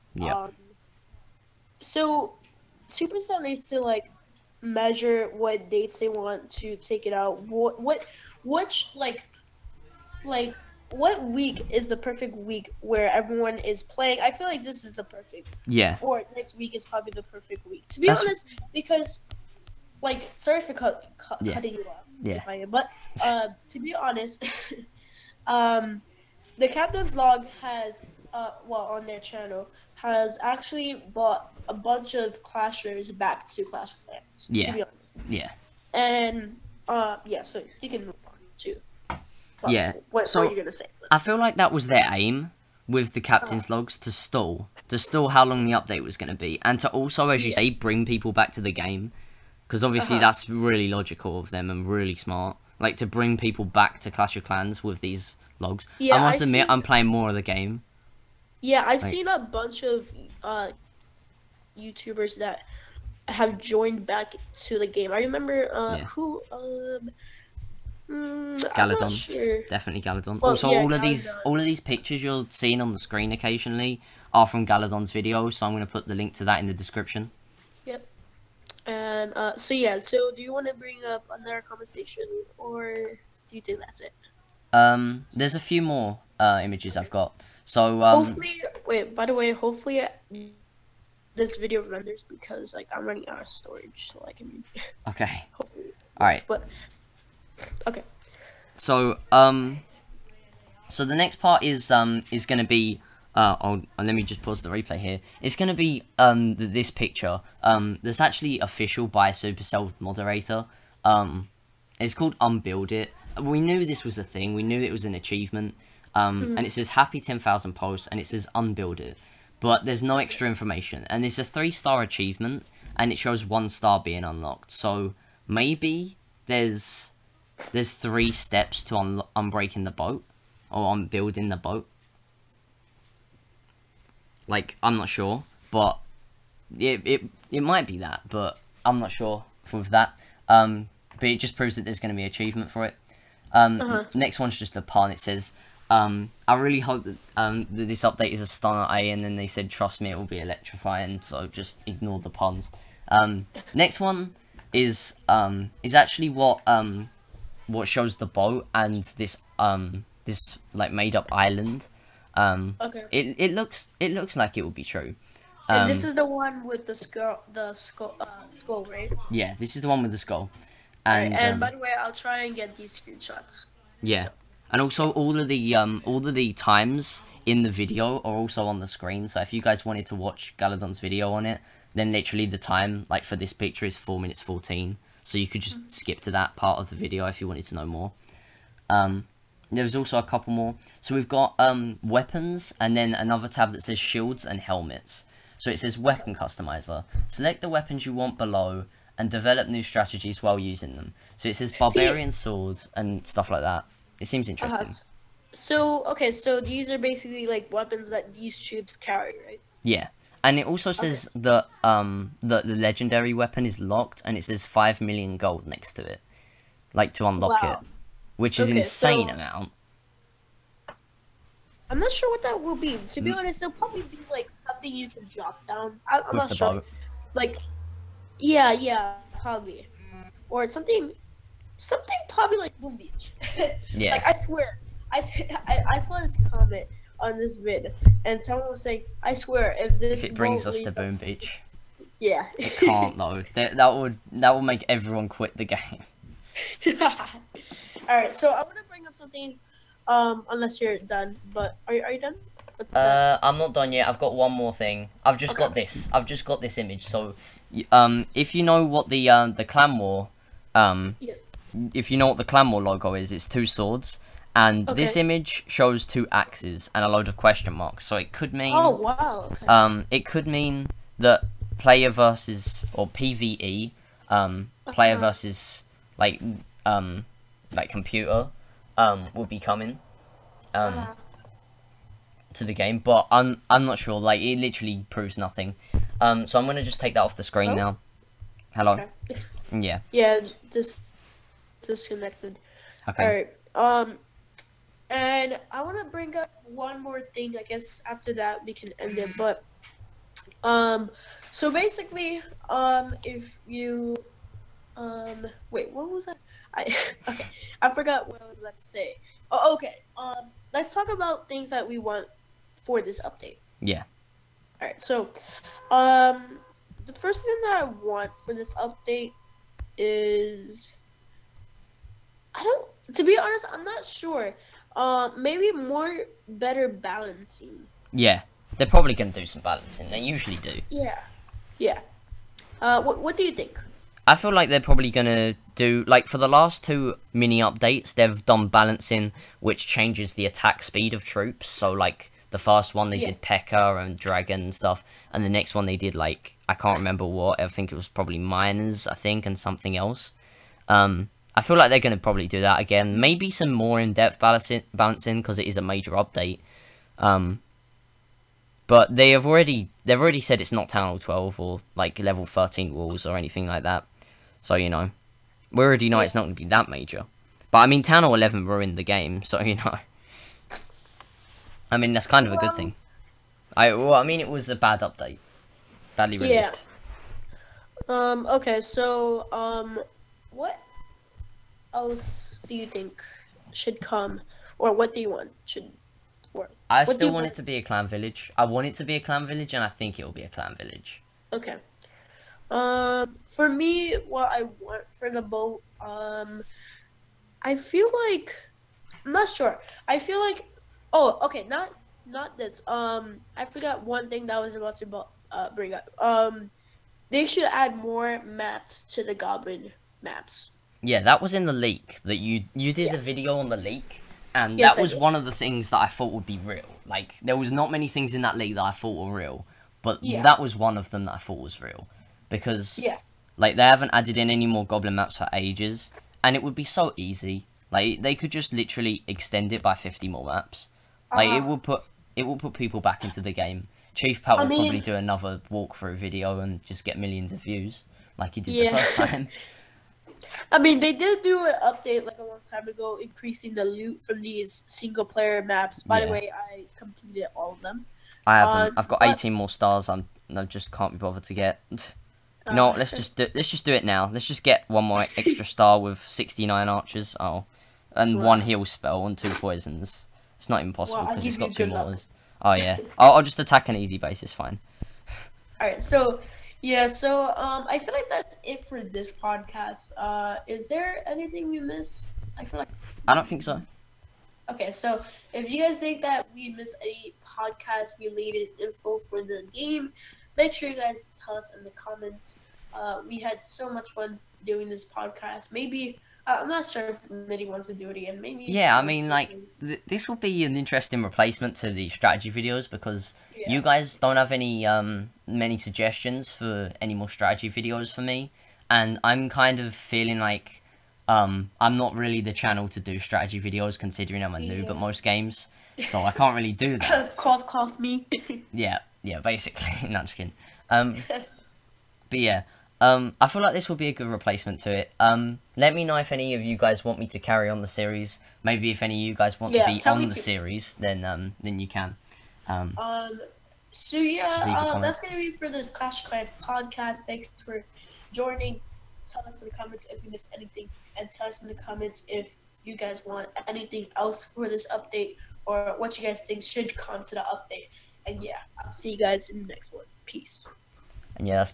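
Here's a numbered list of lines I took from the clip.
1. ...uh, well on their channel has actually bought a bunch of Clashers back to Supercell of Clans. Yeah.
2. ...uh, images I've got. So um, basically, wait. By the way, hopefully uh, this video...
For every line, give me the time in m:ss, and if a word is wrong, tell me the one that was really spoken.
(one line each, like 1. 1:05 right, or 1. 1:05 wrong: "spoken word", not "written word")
1. 0:28 wrong: "Clash", not "Supercell"
2. 1:26 wrong: "hopefully", not "basically".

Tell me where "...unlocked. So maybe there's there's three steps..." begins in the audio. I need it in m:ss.
2:04.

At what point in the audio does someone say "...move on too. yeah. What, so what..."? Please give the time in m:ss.
0:38.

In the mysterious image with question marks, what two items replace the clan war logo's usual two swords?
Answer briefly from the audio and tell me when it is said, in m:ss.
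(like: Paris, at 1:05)
two axes, at 4:26.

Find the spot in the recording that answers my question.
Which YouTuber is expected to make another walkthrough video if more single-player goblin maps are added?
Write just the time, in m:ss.
7:14.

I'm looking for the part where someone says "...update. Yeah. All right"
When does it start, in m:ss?
5:13.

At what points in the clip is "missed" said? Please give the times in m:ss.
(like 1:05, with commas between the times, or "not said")
7:51, 7:56, 8:50.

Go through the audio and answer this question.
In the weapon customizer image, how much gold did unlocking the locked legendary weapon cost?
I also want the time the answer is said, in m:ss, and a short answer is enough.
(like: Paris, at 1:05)
5 million gold, at 3:34.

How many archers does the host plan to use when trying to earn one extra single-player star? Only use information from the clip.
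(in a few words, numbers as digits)
69.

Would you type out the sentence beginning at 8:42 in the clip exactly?
Um, um so yeah, uh, that's gonna be for this Clash Clans podcast.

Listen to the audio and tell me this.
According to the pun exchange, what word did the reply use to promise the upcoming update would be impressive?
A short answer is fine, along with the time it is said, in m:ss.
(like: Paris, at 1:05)
electrifying, at 2:30.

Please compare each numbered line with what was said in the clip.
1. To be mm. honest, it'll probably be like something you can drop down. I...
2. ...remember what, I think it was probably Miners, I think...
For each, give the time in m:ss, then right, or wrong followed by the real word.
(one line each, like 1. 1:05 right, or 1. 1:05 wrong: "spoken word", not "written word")
1. 3:43 right
2. 5:46 right.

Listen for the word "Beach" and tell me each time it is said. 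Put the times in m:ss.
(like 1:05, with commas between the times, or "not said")
3:52, 4:01.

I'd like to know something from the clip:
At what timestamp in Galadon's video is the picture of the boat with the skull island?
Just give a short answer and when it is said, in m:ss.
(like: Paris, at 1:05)
4:14, at 3:03.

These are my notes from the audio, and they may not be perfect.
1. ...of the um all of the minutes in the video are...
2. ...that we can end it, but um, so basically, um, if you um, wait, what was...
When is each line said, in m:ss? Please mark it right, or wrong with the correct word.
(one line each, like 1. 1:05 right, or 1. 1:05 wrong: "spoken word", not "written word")
1. 2:55 wrong: "times", not "minutes"
2. 4:58 right.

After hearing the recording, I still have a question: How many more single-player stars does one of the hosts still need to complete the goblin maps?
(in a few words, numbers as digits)
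18.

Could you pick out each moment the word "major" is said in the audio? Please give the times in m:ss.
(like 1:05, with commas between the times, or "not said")
5:55, 6:06.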